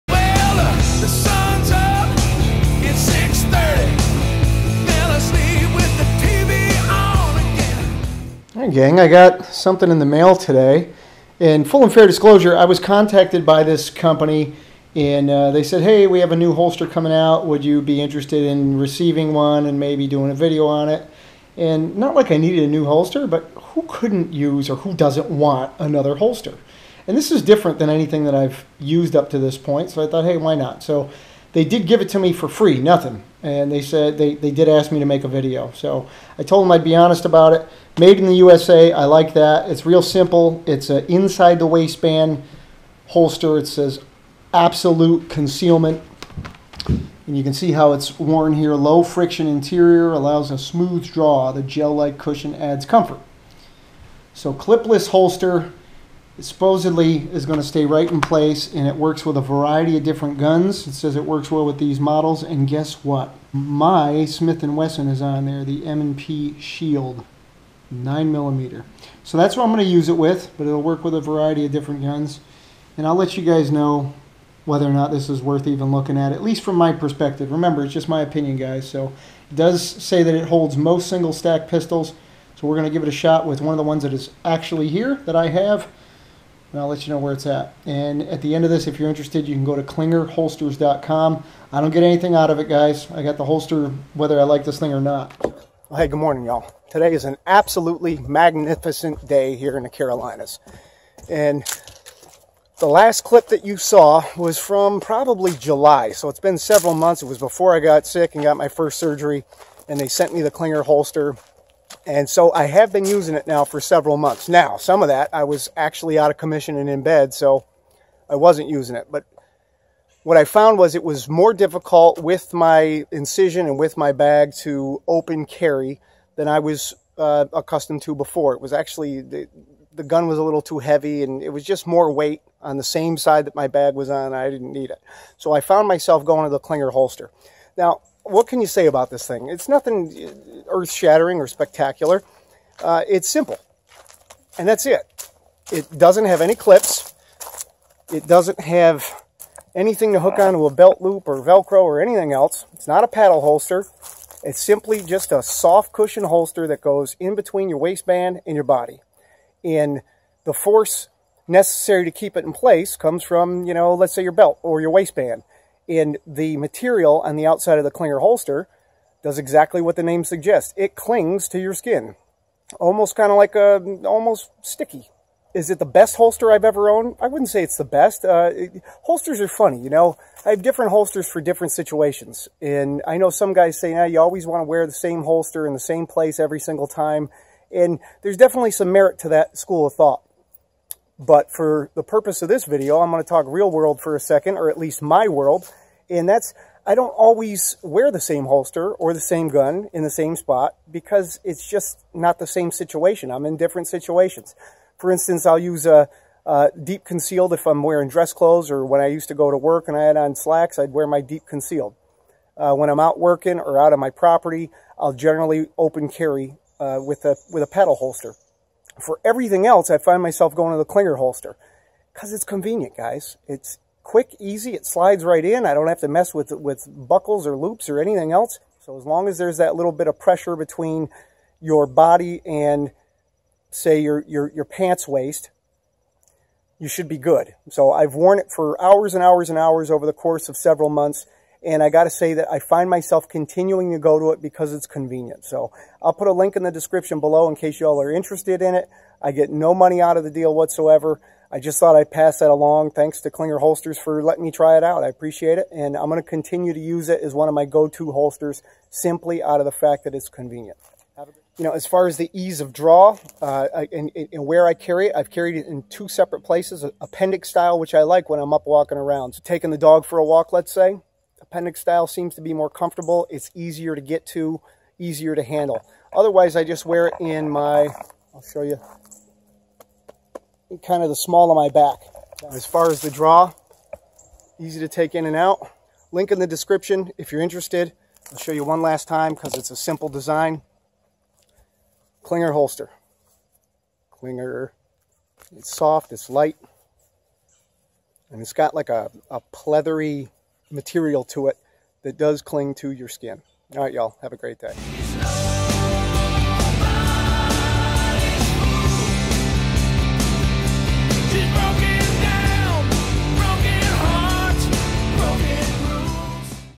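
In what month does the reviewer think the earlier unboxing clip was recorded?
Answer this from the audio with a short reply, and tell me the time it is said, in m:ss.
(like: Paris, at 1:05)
July, at 1:45.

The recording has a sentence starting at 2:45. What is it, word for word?
And the material on the outside of the clinger holster does exactly what the name suggests.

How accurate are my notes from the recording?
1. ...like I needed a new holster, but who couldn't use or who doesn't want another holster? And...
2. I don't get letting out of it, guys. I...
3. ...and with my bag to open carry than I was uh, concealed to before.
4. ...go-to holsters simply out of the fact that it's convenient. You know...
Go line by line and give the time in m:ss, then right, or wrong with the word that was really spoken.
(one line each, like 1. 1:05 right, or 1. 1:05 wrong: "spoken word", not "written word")
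1. 0:22 right
2. 1:31 wrong: "anything", not "letting"
3. 2:03 wrong: "accustomed", not "concealed"
4. 4:17 right.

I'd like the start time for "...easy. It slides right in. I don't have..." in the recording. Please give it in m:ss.
3:44.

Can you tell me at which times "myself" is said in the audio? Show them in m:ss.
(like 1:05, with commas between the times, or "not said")
2:15, 3:40, 4:02.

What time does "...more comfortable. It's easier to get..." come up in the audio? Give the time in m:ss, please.
4:32.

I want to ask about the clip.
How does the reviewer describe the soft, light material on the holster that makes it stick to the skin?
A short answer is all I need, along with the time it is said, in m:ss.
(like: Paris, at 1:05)
pleathery, at 4:59.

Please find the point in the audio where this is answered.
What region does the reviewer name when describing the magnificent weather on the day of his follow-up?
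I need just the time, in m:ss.
1:39.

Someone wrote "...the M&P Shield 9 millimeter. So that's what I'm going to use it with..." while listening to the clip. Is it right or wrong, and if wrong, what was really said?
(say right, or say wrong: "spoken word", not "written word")
right.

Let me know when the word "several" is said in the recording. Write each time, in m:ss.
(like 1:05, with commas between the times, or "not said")
1:46, 1:53, 4:00.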